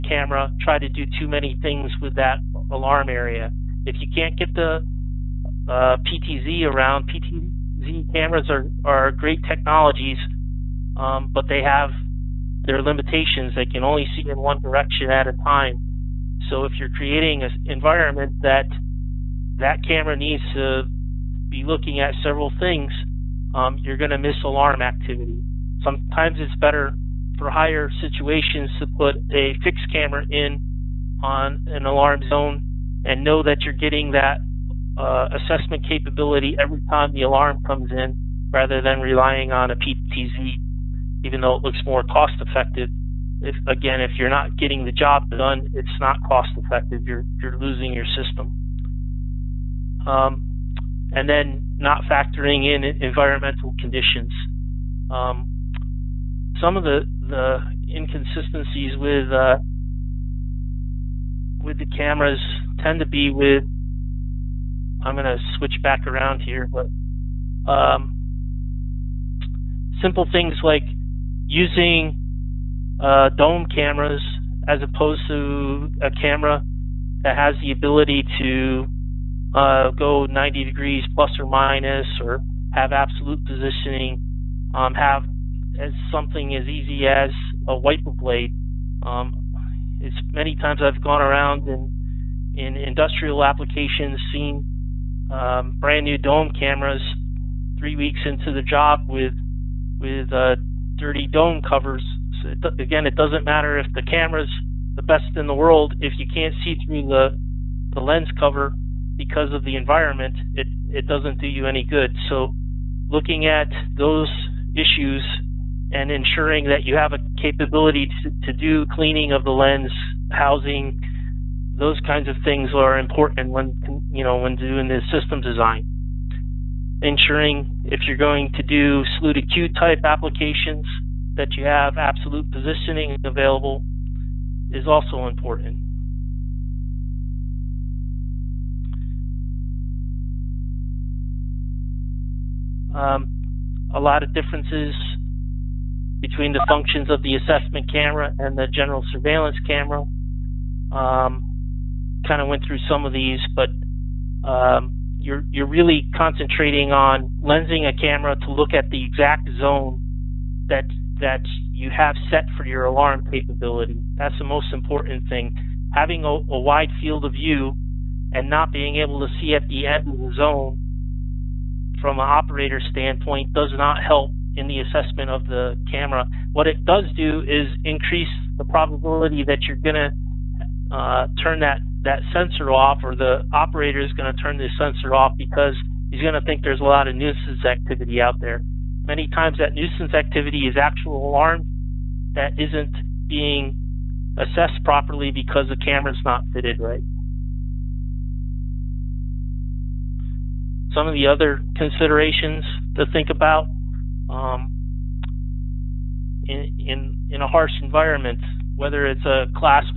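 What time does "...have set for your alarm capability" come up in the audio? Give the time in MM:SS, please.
02:41.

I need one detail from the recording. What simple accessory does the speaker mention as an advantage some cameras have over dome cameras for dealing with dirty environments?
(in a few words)
Wiper blade.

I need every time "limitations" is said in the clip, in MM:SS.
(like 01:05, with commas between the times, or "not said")
00:12.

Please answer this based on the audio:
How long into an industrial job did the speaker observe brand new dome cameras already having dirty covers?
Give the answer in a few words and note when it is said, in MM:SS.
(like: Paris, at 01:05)
3 weeks, at 01:37.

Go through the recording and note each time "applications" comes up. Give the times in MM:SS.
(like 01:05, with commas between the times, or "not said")
01:33, 02:10.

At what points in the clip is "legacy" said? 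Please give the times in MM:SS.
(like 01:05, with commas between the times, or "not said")
not said.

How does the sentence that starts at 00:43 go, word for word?
If again, if you're not getting the job done, it's not cost effective.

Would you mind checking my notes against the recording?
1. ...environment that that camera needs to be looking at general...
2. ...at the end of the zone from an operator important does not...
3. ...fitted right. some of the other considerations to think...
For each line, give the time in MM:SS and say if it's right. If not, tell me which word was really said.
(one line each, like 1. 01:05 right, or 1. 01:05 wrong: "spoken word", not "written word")
1. 00:17 wrong: "several", not "general"
2. 02:49 wrong: "standpoint", not "important"
3. 03:16 right.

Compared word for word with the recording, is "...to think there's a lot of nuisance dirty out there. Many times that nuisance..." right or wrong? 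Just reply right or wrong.
wrong.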